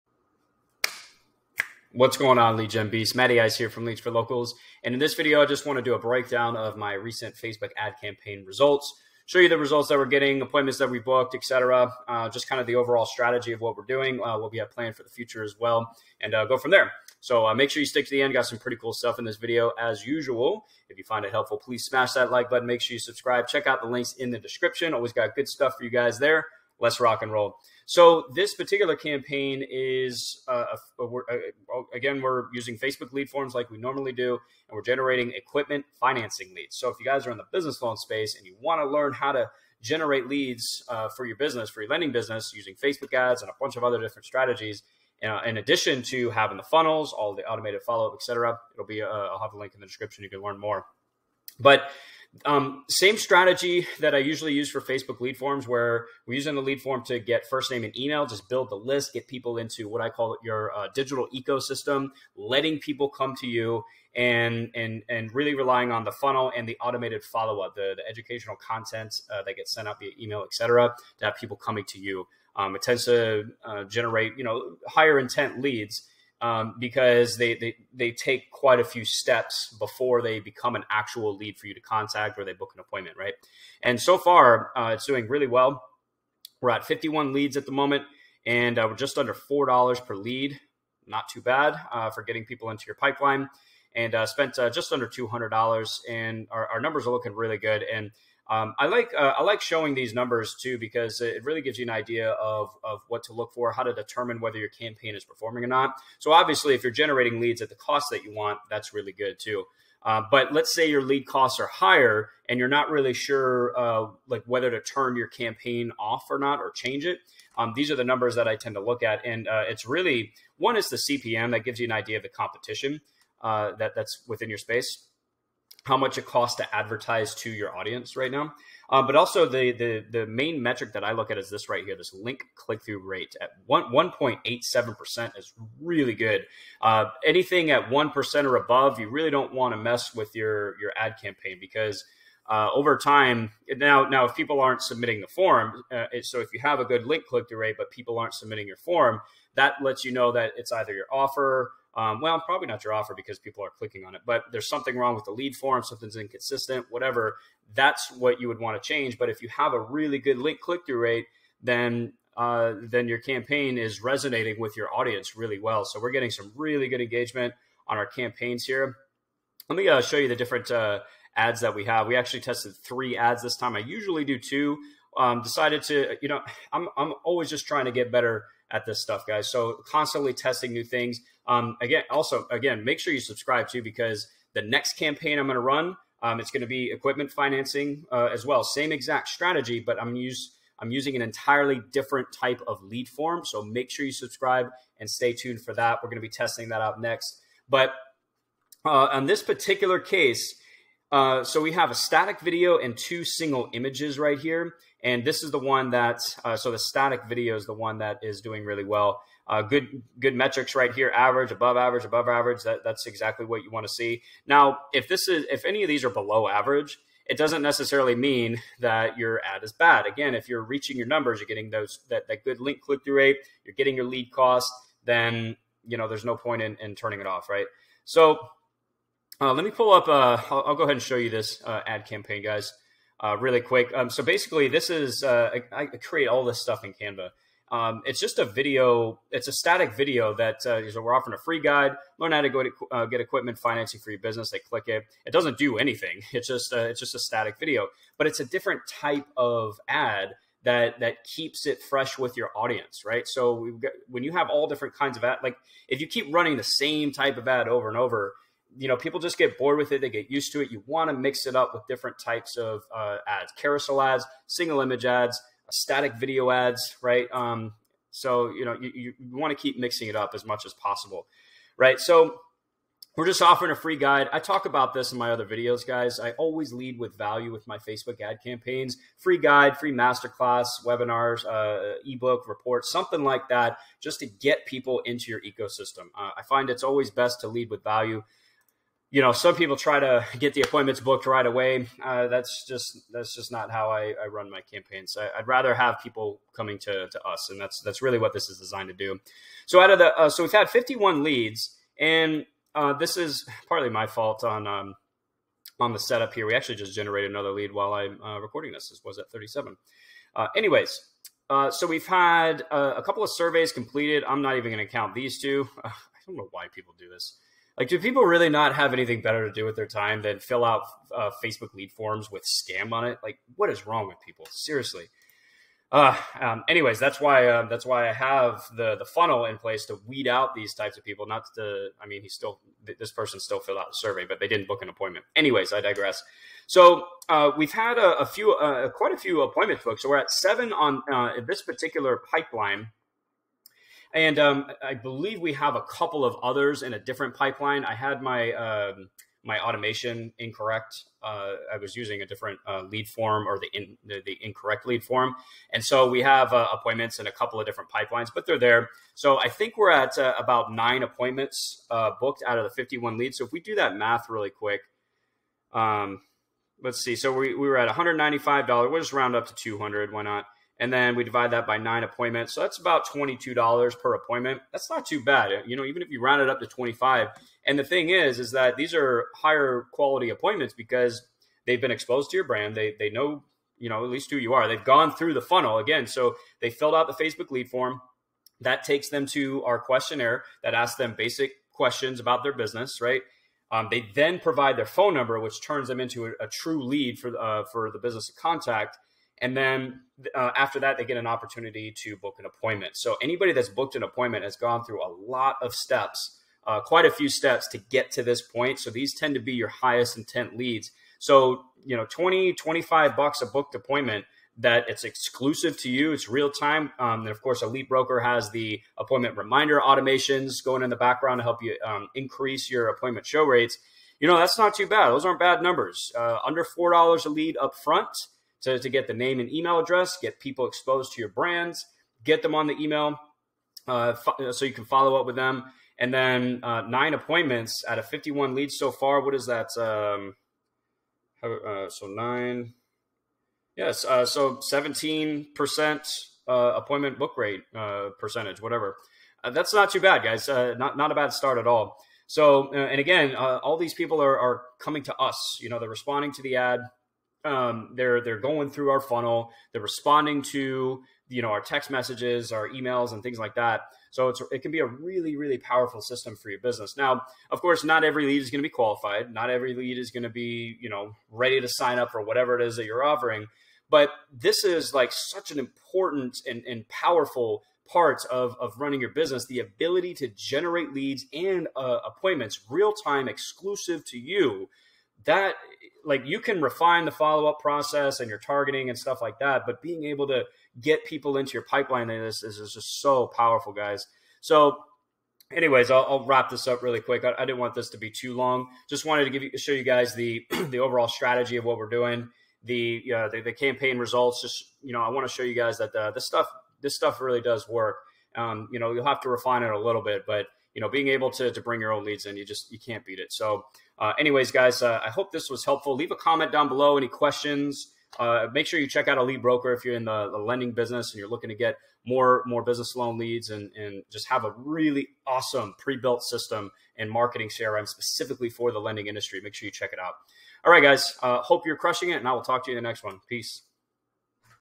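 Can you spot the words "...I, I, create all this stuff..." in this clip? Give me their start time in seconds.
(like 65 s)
235 s.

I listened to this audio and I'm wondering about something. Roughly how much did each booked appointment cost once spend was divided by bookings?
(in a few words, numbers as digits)
$22.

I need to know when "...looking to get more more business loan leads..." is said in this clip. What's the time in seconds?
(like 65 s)
521 s.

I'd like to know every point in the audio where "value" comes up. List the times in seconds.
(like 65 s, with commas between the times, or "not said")
277 s, 287 s.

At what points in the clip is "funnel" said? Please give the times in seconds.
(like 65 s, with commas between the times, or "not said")
46 s, 66 s, 329 s, 385 s, 459 s.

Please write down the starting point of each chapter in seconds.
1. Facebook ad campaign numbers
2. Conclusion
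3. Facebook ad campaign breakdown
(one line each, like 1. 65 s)
1. 55 s
2. 495 s
3. 233 s.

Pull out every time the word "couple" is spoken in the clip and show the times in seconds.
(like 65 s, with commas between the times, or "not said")
313 s, 345 s, 357 s.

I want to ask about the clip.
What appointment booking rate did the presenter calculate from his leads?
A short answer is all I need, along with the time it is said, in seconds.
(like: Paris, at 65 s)
17%, at 444 s.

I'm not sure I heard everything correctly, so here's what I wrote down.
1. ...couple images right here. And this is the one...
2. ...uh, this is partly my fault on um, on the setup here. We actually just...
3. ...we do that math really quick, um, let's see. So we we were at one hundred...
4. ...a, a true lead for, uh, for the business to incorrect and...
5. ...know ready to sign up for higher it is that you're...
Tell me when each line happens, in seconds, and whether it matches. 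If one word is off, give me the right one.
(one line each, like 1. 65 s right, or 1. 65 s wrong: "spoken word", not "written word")
1. 203 s wrong: "single", not "couple"
2. 302 s right
3. 363 s right
4. 396 s wrong: "contact", not "incorrect"
5. 470 s wrong: "whatever", not "higher".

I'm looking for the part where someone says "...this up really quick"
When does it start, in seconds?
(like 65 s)
496 s.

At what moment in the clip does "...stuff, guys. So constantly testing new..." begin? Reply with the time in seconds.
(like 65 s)
179 s.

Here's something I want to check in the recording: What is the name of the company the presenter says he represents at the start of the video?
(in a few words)
Leads for Locals.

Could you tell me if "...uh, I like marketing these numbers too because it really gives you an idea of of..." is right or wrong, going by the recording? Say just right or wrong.
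wrong.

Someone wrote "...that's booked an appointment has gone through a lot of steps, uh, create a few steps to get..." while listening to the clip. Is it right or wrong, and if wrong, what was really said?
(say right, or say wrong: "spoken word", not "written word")
wrong: "quite", not "create".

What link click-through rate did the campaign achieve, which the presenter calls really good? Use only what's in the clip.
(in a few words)
1.87%.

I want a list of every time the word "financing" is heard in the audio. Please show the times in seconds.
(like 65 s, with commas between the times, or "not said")
35 s, 187 s, 243 s.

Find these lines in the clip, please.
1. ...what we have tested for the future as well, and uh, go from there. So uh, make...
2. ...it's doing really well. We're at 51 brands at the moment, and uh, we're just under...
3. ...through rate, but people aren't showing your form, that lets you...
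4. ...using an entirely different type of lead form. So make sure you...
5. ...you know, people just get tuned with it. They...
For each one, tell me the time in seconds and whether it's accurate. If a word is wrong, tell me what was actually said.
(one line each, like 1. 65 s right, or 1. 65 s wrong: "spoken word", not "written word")
1. 14 s wrong: "planned", not "tested"
2. 84 s wrong: "leads", not "brands"
3. 147 s wrong: "submitting", not "showing"
4. 190 s right
5. 258 s wrong: "bored", not "tuned".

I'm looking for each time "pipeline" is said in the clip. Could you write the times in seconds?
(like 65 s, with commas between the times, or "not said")
92 s, 342 s, 347 s, 357 s, 491 s.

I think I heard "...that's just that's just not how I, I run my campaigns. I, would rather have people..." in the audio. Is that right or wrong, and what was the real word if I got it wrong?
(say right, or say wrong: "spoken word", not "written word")
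right.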